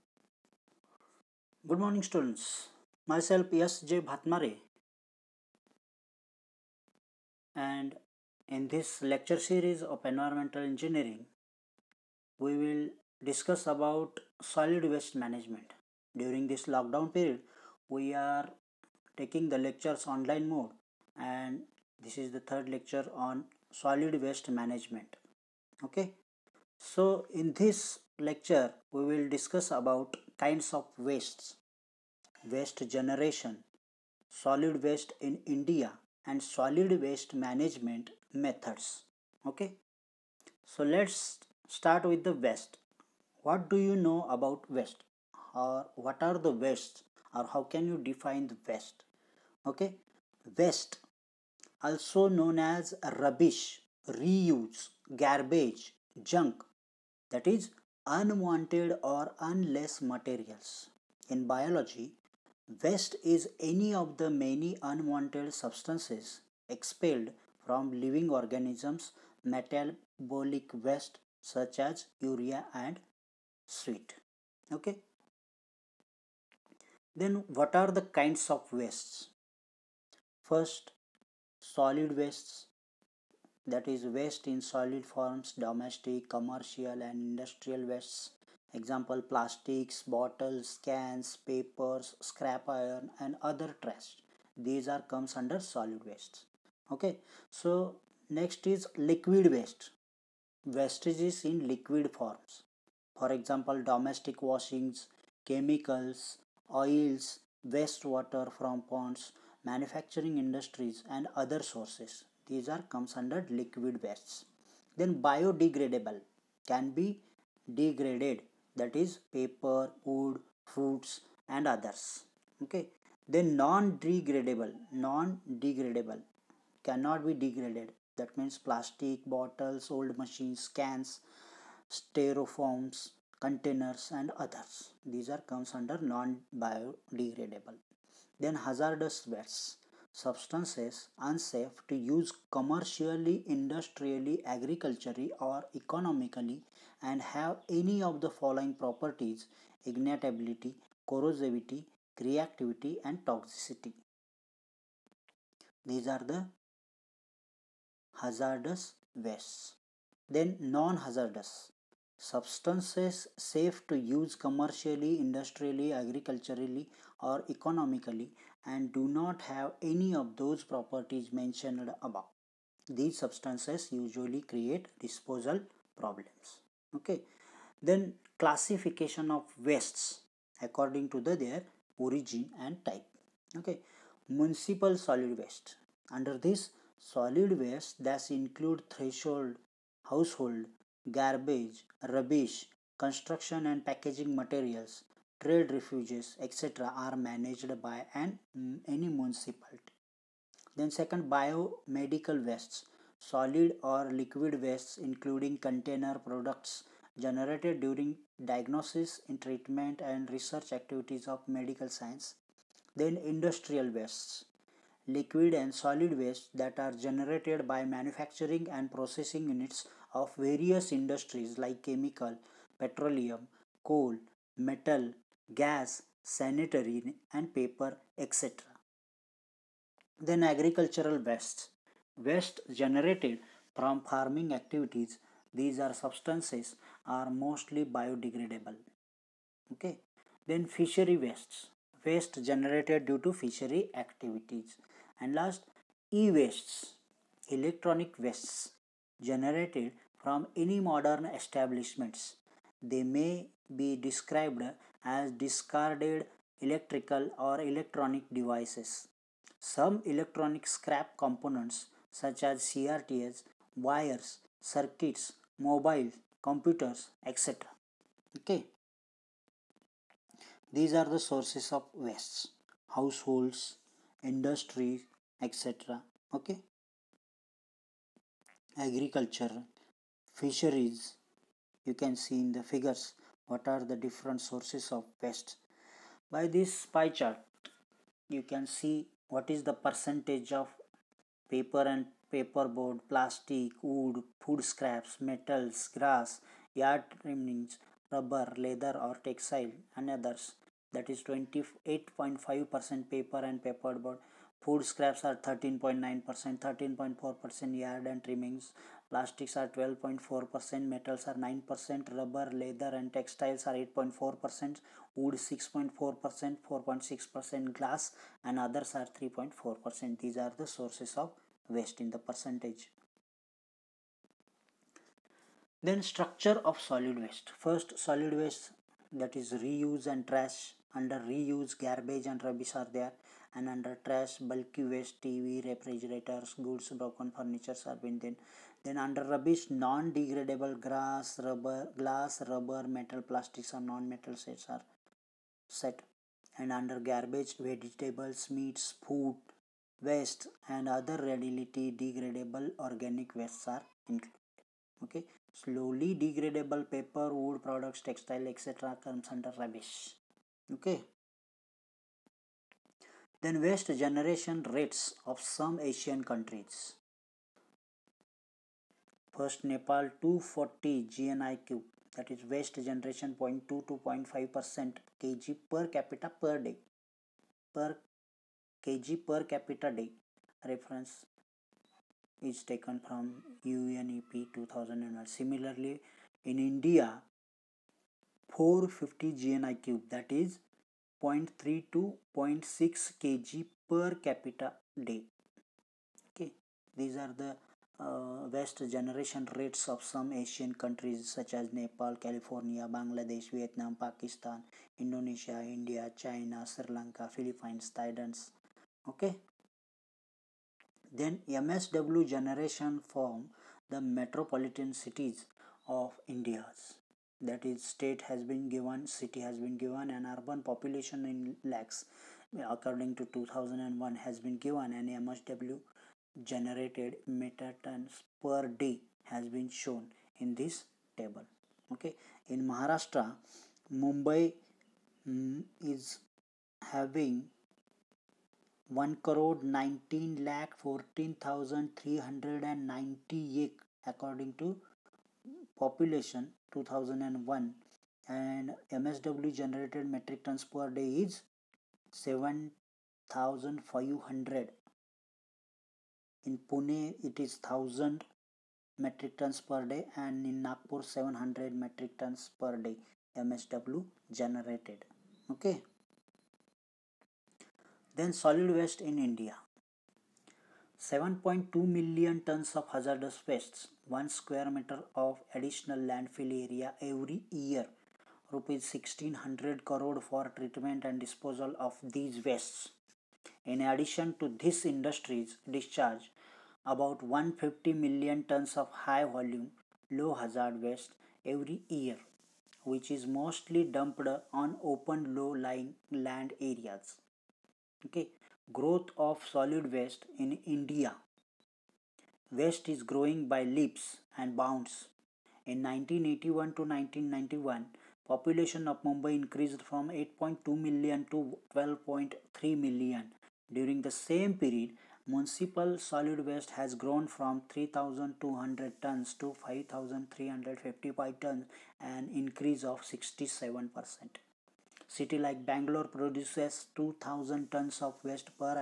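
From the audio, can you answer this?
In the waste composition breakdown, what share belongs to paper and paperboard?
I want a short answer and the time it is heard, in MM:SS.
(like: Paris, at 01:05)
28.5%, at 05:01.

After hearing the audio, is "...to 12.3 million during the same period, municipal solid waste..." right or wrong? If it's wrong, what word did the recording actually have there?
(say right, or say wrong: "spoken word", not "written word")
right.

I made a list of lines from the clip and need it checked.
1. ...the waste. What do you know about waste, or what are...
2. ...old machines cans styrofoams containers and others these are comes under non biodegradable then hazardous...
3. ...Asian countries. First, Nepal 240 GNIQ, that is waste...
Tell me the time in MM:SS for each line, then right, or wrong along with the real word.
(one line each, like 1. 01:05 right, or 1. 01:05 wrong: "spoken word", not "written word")
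1. 00:42 right
2. 02:09 right
3. 06:05 right.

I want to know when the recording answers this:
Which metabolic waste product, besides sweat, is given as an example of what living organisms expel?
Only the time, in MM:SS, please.
01:12.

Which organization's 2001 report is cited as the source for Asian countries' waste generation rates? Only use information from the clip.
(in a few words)
UNEP.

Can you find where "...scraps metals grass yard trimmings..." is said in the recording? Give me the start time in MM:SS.
04:54.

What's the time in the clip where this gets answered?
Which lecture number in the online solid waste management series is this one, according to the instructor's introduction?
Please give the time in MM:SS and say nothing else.
00:22.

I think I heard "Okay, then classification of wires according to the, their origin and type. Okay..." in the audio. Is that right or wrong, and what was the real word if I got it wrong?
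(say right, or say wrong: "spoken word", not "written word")
wrong: "wastes", not "wires".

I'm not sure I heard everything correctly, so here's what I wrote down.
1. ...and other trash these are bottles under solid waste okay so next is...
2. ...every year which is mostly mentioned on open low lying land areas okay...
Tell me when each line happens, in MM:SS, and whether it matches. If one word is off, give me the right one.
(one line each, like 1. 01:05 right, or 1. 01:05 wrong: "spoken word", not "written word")
1. 01:33 wrong: "comes", not "bottles"
2. 08:11 wrong: "dumped", not "mentioned".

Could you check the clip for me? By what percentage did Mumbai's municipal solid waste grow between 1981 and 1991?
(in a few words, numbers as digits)
67%.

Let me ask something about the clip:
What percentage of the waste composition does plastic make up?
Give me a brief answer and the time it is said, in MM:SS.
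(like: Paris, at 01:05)
12.4%, at 05:09.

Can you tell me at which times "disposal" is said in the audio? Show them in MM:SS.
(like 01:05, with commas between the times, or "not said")
02:54, 08:01.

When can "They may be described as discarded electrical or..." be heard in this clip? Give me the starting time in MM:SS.
04:12.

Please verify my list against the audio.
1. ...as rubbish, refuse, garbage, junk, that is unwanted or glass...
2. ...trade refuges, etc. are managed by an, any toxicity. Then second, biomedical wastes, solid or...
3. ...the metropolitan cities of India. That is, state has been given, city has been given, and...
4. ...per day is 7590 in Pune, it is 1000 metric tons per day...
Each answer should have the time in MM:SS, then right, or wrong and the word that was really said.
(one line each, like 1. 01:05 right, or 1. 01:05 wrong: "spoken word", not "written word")
1. 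00:52 wrong: "unless", not "glass"
2. 03:15 wrong: "municipality", not "toxicity"
3. 06:53 right
4. 07:30 wrong: "7500", not "7590".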